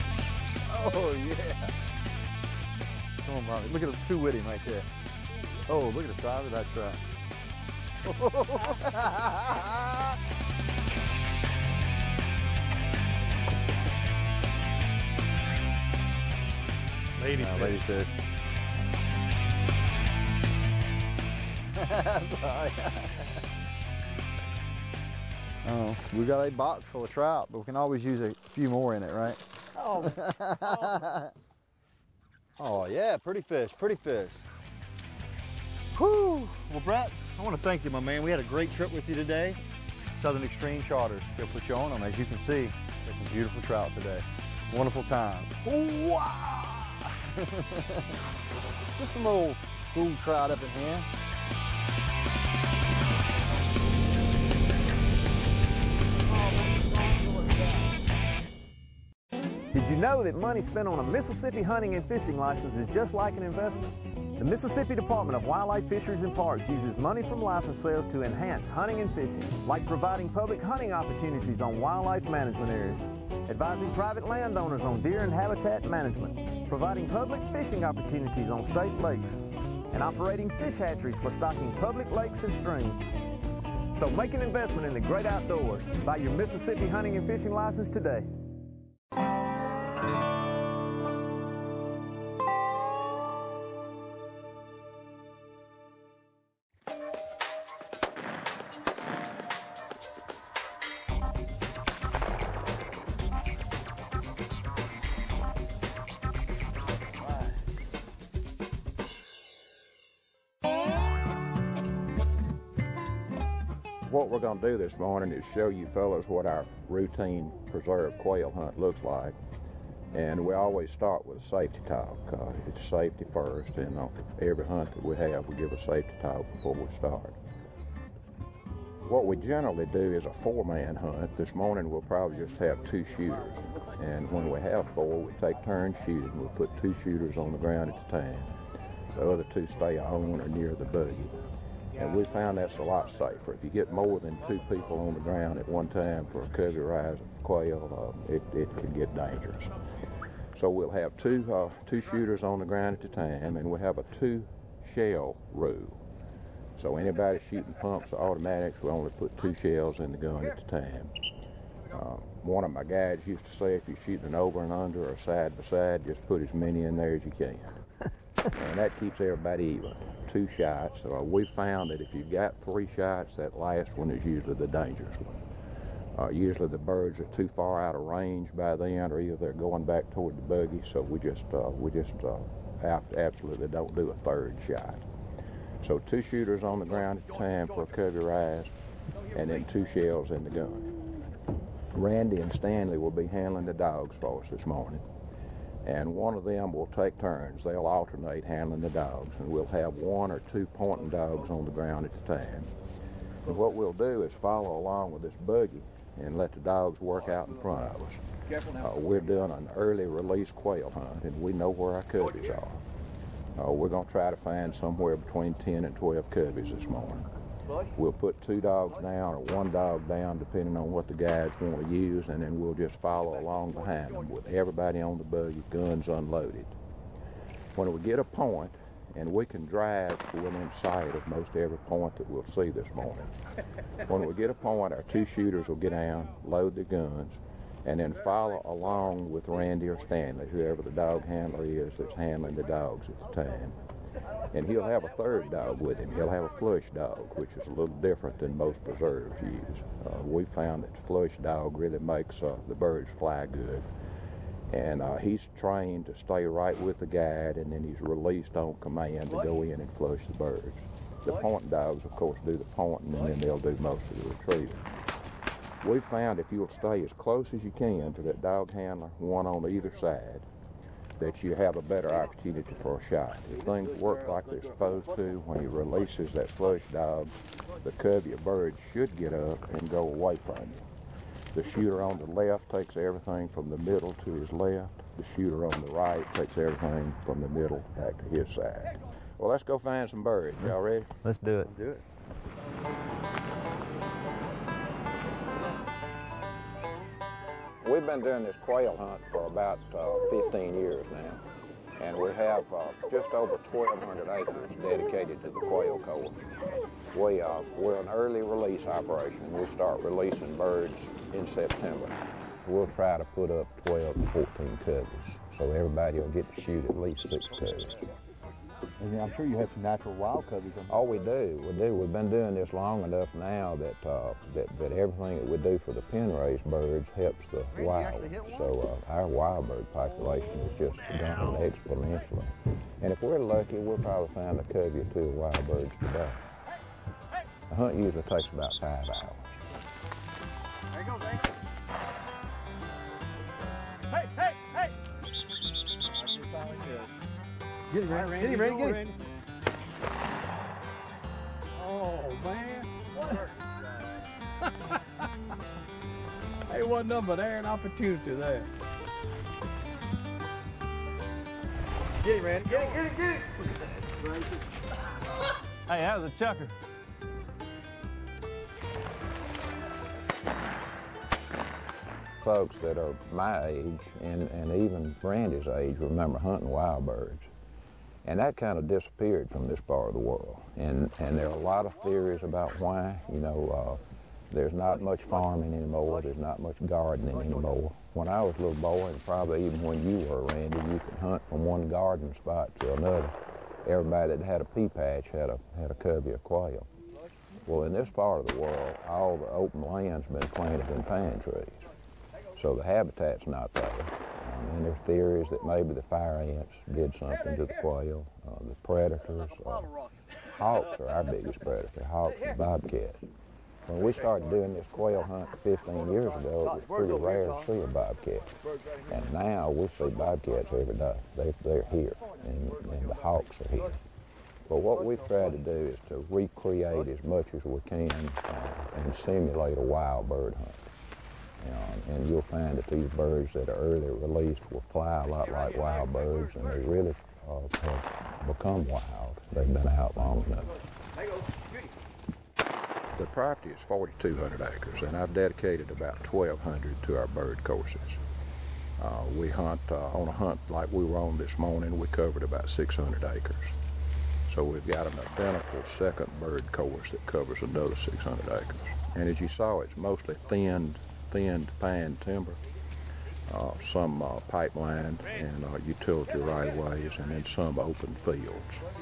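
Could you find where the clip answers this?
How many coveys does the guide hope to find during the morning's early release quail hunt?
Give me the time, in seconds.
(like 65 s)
215 s.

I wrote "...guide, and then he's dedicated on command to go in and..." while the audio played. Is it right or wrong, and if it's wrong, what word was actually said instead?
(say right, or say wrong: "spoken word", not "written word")
wrong: "released", not "dedicated".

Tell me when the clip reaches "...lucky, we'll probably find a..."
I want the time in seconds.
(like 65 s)
333 s.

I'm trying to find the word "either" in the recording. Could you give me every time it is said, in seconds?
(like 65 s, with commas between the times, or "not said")
179 s, 269 s.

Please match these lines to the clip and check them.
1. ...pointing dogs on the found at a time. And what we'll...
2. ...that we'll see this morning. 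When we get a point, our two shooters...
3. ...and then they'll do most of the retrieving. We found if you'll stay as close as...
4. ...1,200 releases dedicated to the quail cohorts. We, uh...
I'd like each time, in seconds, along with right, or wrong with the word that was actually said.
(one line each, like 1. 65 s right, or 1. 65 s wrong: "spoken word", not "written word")
1. 200 s wrong: "ground", not "found"
2. 232 s right
3. 263 s right
4. 303 s wrong: "acres", not "releases".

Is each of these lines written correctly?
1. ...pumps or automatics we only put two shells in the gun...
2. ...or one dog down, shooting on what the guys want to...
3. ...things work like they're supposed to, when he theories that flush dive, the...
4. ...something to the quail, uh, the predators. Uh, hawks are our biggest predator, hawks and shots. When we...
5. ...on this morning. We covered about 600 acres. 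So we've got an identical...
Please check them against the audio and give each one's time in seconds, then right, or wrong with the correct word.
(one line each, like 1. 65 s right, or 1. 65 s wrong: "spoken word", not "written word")
1. 157 s right
2. 219 s wrong: "depending", not "shooting"
3. 273 s wrong: "releases", not "theories"
4. 407 s wrong: "bobcats", not "shots"
5. 451 s right.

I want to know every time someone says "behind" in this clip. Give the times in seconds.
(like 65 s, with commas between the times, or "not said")
223 s.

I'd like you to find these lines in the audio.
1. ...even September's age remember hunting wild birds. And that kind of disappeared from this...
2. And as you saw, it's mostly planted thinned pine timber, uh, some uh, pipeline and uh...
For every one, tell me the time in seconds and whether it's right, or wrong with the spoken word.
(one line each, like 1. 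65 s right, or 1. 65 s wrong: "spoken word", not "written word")
1. 374 s wrong: "Randy", not "September"
2. 459 s wrong: "thinned", not "planted".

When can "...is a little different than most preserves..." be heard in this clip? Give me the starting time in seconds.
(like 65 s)
247 s.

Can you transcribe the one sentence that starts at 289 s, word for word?
Well, let's go find some birds.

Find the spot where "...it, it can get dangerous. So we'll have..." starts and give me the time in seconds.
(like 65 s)
148 s.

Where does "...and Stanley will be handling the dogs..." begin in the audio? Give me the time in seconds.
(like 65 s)
192 s.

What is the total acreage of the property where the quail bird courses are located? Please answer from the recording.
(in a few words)
4,200 acres.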